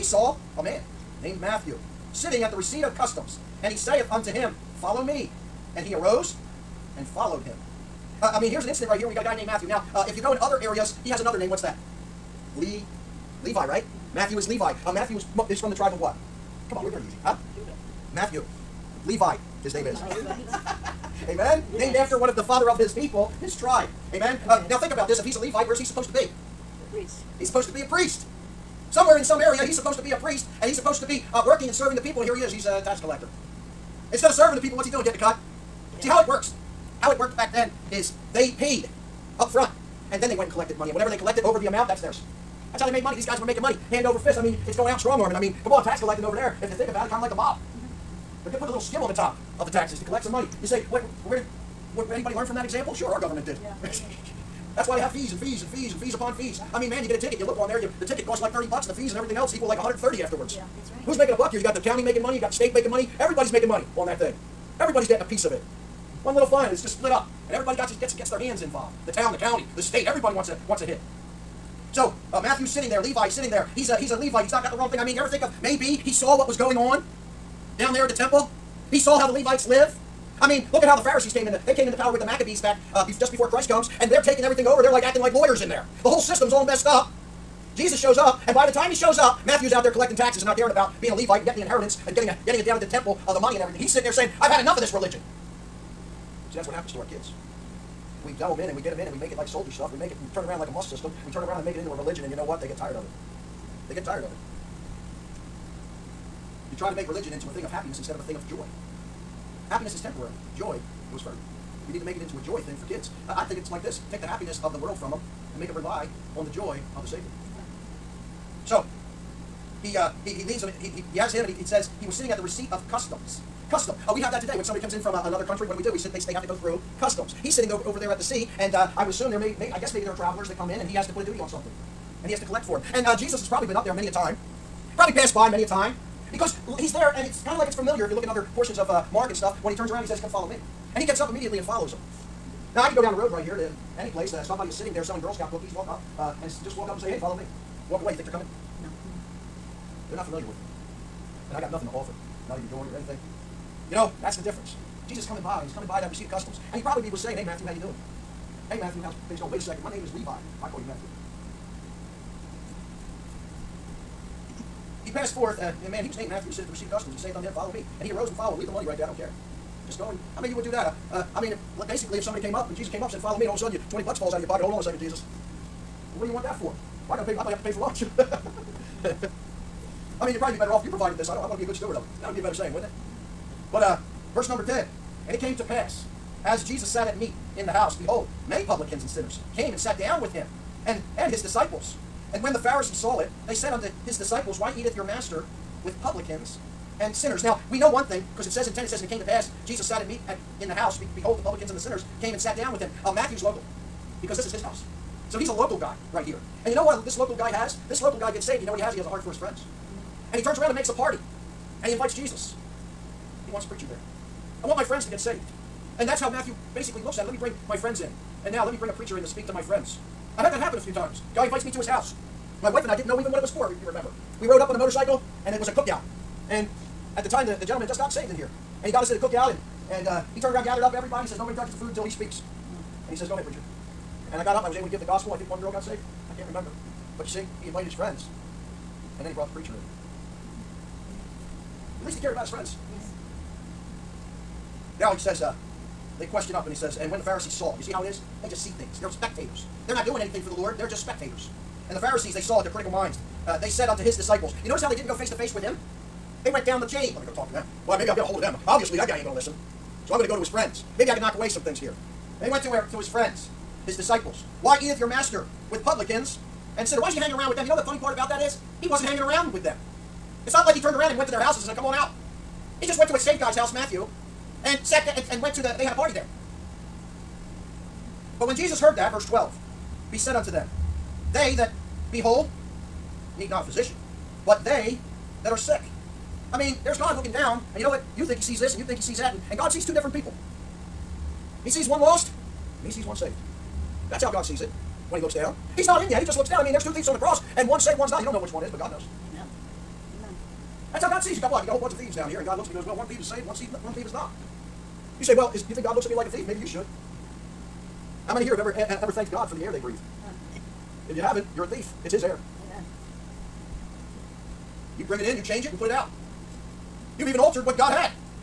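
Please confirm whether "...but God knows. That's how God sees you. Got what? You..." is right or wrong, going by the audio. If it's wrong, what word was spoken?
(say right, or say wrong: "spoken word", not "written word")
right.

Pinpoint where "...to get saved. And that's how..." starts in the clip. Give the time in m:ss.
3:35.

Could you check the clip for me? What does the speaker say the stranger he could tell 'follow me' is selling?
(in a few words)
Girl Scout cookies.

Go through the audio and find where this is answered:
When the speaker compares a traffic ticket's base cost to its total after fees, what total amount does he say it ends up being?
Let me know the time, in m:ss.
0:59.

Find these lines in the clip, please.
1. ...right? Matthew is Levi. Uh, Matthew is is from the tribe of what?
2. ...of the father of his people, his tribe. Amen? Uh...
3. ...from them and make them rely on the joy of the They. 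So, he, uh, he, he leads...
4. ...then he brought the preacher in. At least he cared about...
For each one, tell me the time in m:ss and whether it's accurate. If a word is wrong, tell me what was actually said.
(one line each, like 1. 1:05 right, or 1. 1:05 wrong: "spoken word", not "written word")
1. 0:13 right
2. 0:22 right
3. 1:54 wrong: "Savior", not "They"
4. 3:59 right.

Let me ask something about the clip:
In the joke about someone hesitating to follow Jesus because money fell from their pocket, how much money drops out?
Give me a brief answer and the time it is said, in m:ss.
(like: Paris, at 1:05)
20 bucks, at 2:53.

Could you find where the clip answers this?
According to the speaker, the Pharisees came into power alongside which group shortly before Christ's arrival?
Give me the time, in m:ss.
1:22.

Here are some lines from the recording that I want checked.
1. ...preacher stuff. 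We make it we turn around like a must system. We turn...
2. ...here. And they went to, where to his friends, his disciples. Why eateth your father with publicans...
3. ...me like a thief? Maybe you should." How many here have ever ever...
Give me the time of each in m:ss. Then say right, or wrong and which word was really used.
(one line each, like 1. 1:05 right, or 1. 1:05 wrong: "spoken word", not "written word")
1. 1:39 wrong: "soldier", not "preacher"
2. 4:21 wrong: "master", not "father"
3. 5:06 right.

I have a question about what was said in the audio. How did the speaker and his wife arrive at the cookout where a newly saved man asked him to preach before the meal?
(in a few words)
On a motorcycle.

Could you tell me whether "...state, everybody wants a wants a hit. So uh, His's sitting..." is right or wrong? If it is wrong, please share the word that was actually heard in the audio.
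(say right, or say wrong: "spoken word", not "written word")
wrong: "Matthew", not "His".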